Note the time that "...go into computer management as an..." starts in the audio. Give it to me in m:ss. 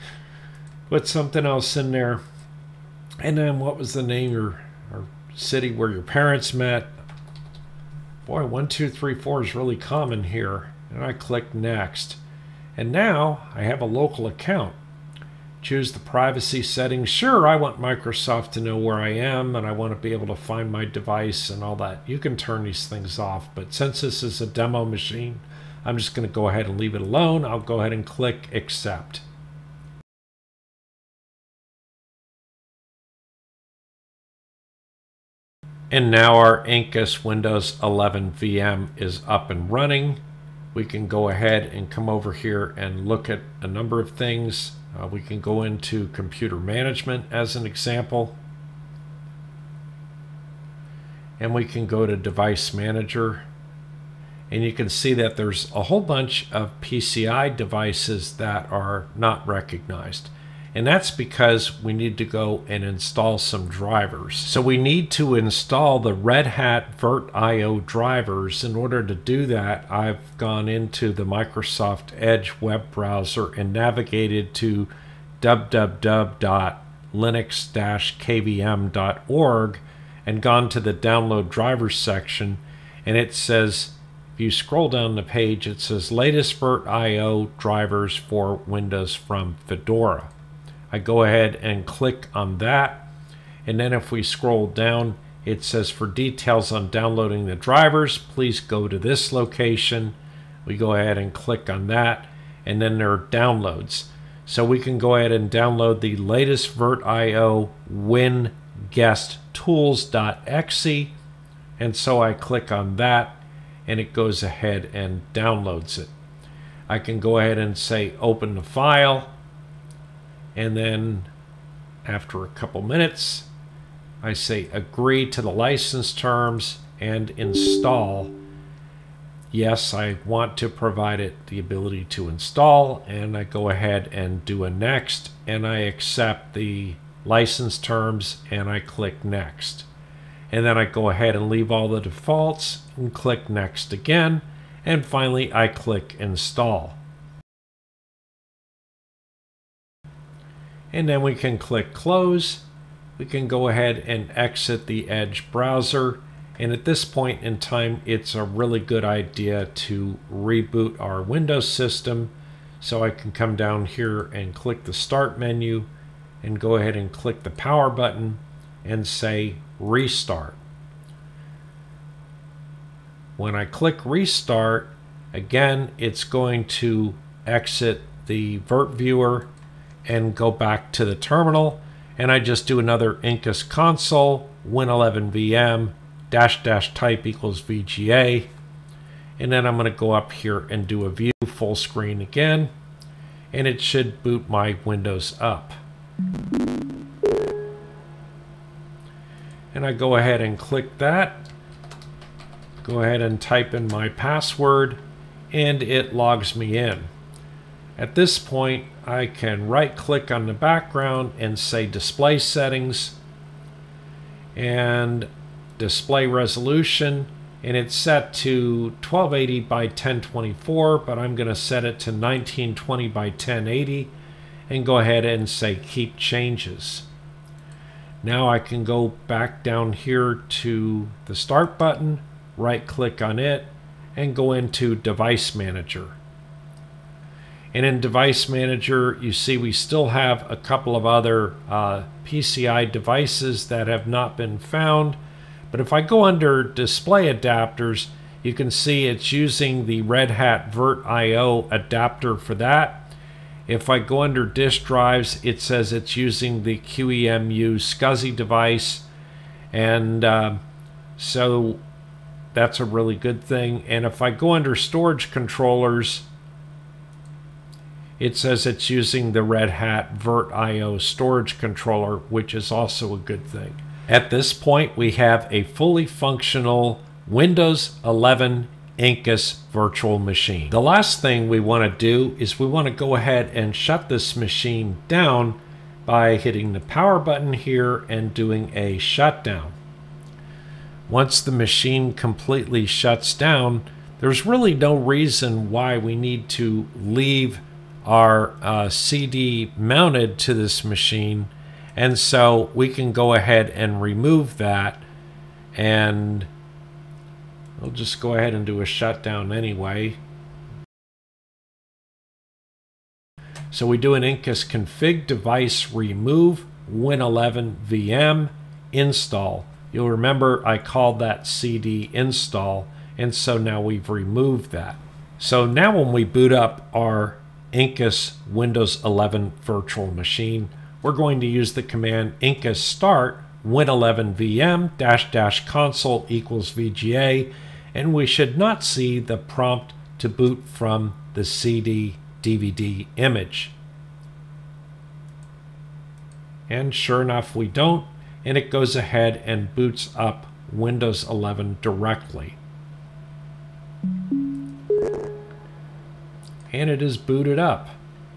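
0:45.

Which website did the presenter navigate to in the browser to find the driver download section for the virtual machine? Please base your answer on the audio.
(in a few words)
www.linux-kvm.org.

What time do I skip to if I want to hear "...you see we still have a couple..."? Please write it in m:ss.
3:59.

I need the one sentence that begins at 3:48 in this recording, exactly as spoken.
Now I can go back down here to the start button, right click on it and go into device manager.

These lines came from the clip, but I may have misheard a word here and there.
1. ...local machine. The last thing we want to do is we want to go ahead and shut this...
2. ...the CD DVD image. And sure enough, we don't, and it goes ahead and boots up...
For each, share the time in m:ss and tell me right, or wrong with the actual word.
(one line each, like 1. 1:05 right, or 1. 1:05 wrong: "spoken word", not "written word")
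1. 4:39 wrong: "virtual", not "local"
2. 5:41 right.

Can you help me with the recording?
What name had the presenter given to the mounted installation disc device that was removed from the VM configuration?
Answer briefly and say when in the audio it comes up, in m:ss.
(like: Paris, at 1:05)
CD install, at 5:21.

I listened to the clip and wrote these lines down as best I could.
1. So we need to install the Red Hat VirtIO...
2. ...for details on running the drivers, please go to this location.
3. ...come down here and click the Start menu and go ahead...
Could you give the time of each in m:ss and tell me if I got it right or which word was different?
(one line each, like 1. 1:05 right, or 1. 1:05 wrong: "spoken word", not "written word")
1. 1:04 right
2. 1:35 wrong: "downloading", not "running"
3. 2:43 right.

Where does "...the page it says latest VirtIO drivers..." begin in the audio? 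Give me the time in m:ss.
1:25.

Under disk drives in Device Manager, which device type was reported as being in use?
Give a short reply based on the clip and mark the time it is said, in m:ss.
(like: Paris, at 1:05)
QEMU SCSI device, at 4:16.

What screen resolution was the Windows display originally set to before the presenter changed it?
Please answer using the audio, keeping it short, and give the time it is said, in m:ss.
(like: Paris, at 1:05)
1280 by 1024, at 3:39.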